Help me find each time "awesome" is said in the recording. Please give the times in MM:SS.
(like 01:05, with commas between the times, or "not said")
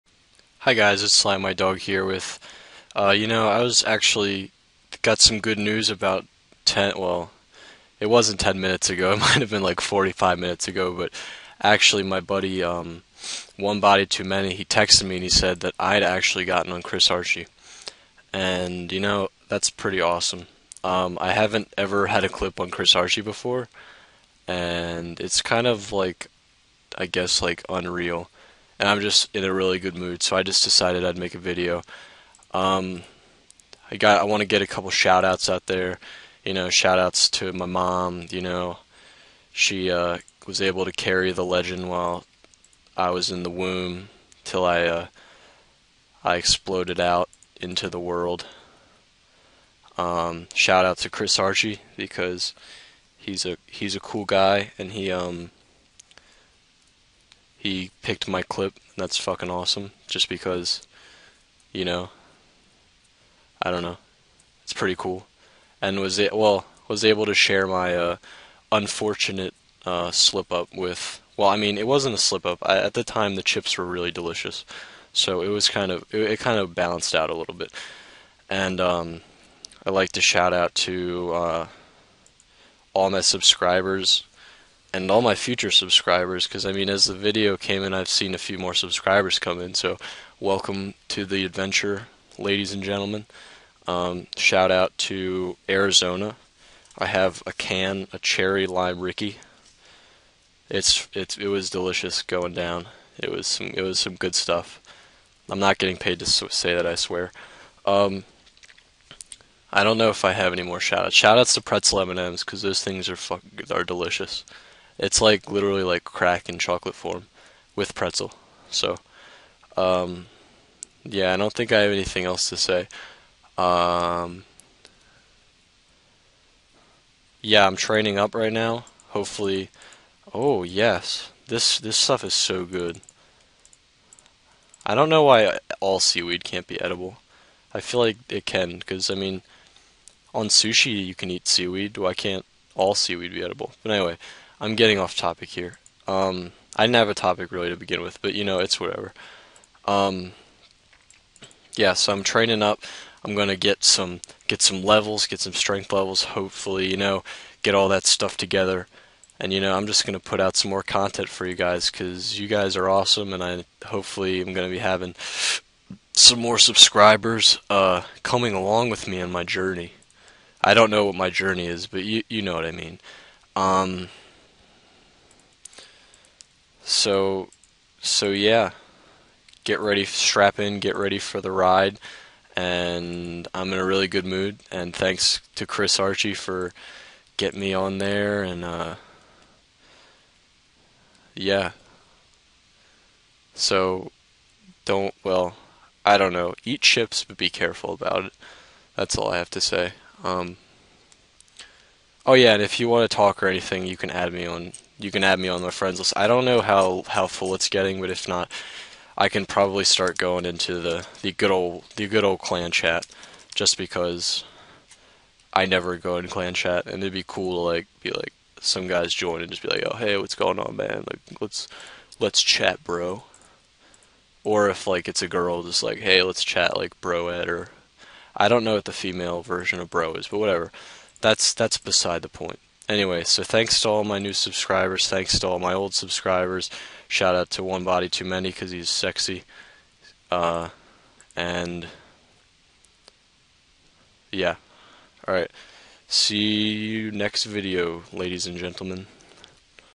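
00:19, 00:59, 02:42.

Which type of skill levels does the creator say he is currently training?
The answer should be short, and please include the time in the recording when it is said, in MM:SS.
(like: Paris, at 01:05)
strength, at 02:35.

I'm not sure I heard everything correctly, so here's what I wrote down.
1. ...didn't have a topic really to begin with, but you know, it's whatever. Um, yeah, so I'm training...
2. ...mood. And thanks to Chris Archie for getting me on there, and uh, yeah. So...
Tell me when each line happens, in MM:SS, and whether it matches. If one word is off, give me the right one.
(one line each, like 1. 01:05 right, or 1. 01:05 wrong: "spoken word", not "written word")
1. 02:26 right
2. 03:04 right.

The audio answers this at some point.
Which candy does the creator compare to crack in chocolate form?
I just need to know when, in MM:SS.
01:51.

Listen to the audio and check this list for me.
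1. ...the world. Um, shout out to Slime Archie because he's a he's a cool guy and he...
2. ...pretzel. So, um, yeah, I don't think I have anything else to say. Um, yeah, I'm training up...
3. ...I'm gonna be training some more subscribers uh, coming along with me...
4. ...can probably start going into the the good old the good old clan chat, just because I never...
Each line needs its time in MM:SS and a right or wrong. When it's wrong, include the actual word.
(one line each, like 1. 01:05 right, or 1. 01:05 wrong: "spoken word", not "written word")
1. 00:47 wrong: "Chris", not "Slime"
2. 01:57 right
3. 02:44 wrong: "having", not "training"
4. 03:29 right.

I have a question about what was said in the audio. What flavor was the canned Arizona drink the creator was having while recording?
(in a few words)
cherry lime Rickey.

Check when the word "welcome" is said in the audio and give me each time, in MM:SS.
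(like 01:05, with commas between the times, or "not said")
01:30.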